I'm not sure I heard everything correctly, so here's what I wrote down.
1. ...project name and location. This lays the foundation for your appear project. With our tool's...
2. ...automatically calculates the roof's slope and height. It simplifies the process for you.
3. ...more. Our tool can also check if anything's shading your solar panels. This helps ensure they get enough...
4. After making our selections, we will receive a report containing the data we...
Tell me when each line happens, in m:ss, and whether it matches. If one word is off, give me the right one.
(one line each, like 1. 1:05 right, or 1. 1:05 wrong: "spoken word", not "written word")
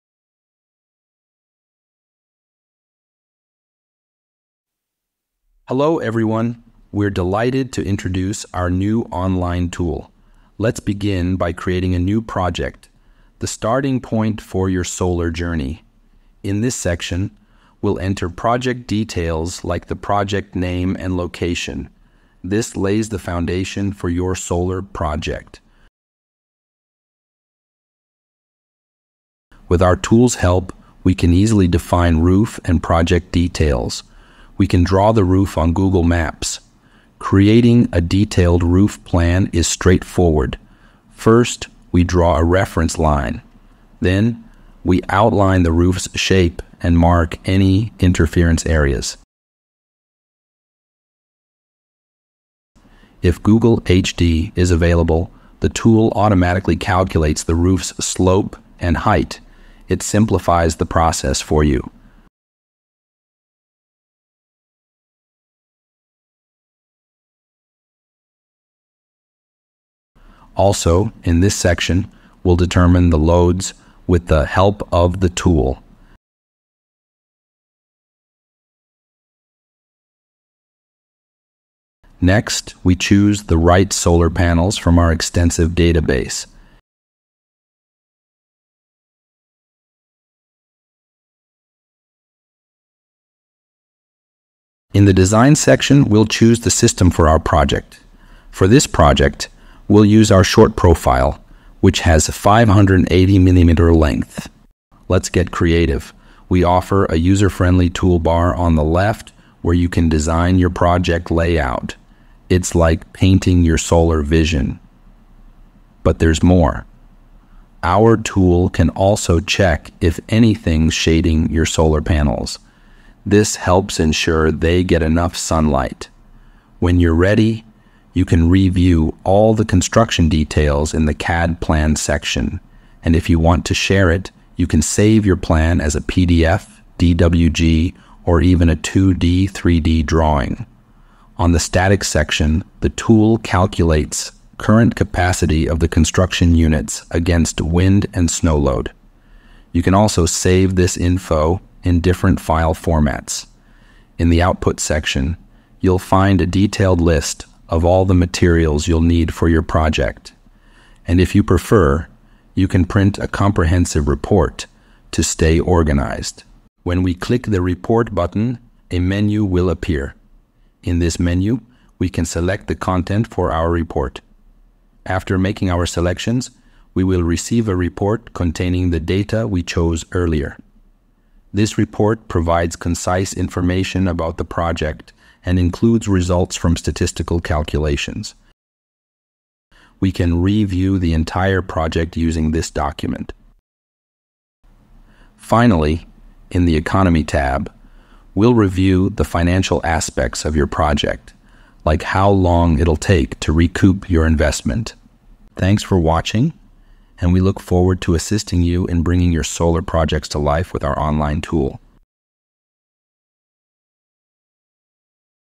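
1. 0:19 wrong: "solar", not "appear"
2. 0:56 right
3. 1:56 right
4. 2:55 right.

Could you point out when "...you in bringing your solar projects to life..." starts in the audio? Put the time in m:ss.
3:28.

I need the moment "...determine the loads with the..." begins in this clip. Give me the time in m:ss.
1:12.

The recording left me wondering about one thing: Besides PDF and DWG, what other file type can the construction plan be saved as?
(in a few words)
2D, 3D drawing.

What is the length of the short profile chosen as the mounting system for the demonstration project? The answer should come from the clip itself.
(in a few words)
580 millimeters.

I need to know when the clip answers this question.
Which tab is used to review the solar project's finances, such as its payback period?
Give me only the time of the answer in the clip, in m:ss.
3:16.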